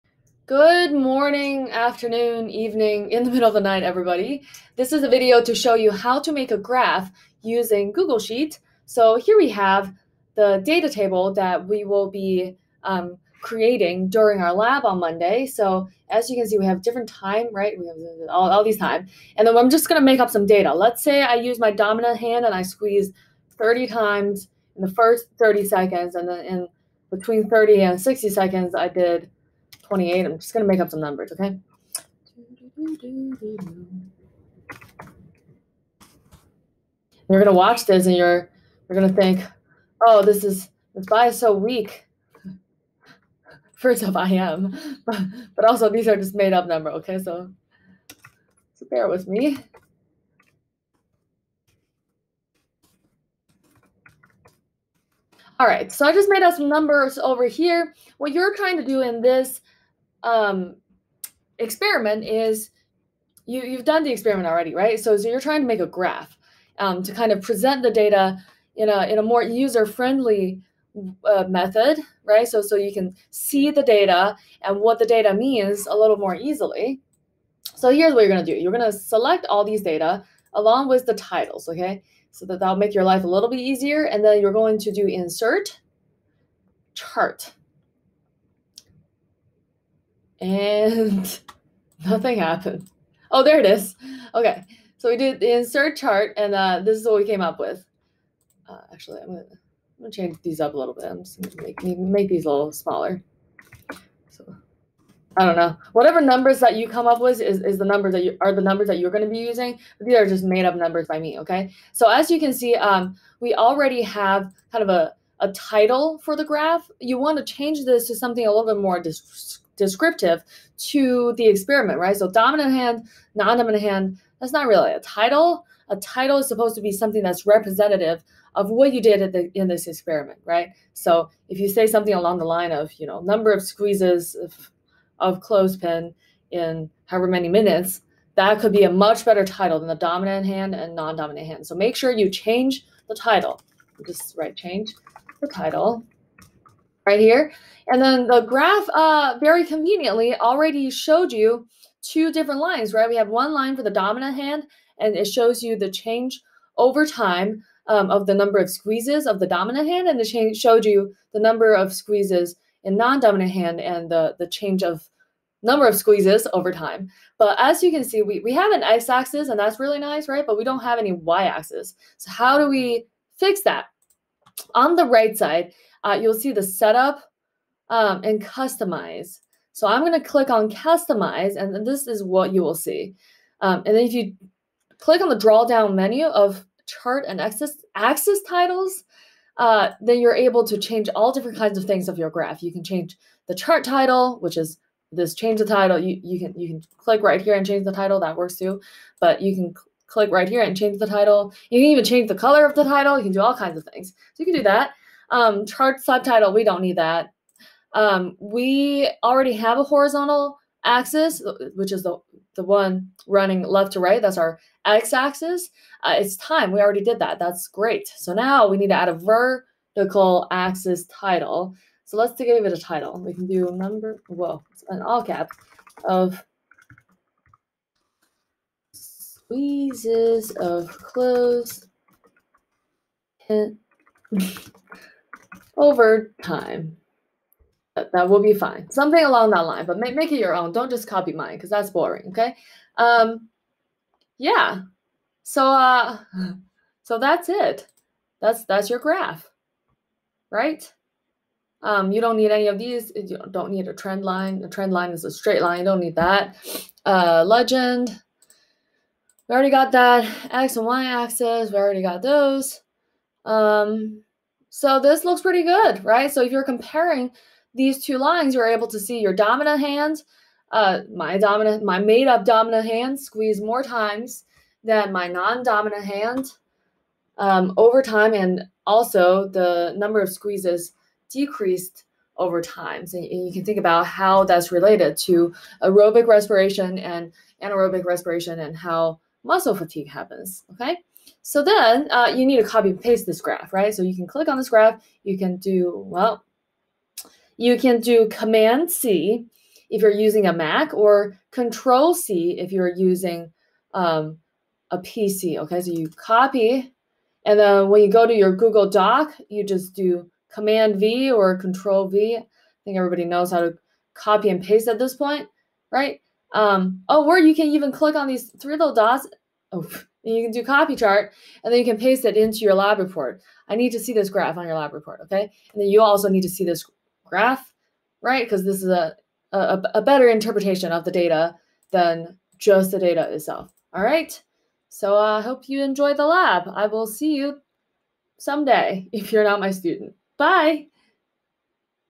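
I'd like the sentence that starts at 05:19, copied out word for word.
Oh, and you can do copy chart, and then you can paste it into your lab report.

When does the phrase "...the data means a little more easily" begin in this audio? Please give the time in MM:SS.
01:14.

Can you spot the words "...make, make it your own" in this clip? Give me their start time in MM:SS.
03:59.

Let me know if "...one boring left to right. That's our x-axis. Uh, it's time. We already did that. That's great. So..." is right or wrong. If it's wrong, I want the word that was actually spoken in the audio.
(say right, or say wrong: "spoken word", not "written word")
wrong: "running", not "boring".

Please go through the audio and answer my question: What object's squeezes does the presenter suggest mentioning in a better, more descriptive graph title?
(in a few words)
clothespin.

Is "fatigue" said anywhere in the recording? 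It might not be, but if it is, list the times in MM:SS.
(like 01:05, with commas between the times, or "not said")
04:49.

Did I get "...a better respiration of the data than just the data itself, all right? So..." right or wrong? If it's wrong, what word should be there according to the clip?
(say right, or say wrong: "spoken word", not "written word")
wrong: "interpretation", not "respiration".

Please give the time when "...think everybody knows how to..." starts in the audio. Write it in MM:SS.
05:12.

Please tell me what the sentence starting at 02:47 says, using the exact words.
But as you can see, we, we have an x-axis, and that's really nice, right?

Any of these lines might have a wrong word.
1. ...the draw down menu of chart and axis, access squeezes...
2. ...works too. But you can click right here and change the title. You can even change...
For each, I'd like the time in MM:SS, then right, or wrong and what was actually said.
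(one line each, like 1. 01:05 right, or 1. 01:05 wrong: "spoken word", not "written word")
1. 03:05 wrong: "titles", not "squeezes"
2. 03:18 right.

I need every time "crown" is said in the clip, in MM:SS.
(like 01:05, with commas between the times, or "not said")
not said.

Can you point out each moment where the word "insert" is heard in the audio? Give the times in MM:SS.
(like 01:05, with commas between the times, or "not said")
01:25, 01:35.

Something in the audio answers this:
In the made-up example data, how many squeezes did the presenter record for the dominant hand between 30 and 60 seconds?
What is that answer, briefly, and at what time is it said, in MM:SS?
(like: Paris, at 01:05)
28, at 00:29.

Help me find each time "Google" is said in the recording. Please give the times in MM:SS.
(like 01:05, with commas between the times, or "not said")
00:07, 05:08.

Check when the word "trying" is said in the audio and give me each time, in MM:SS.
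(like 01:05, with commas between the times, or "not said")
00:58, 01:05.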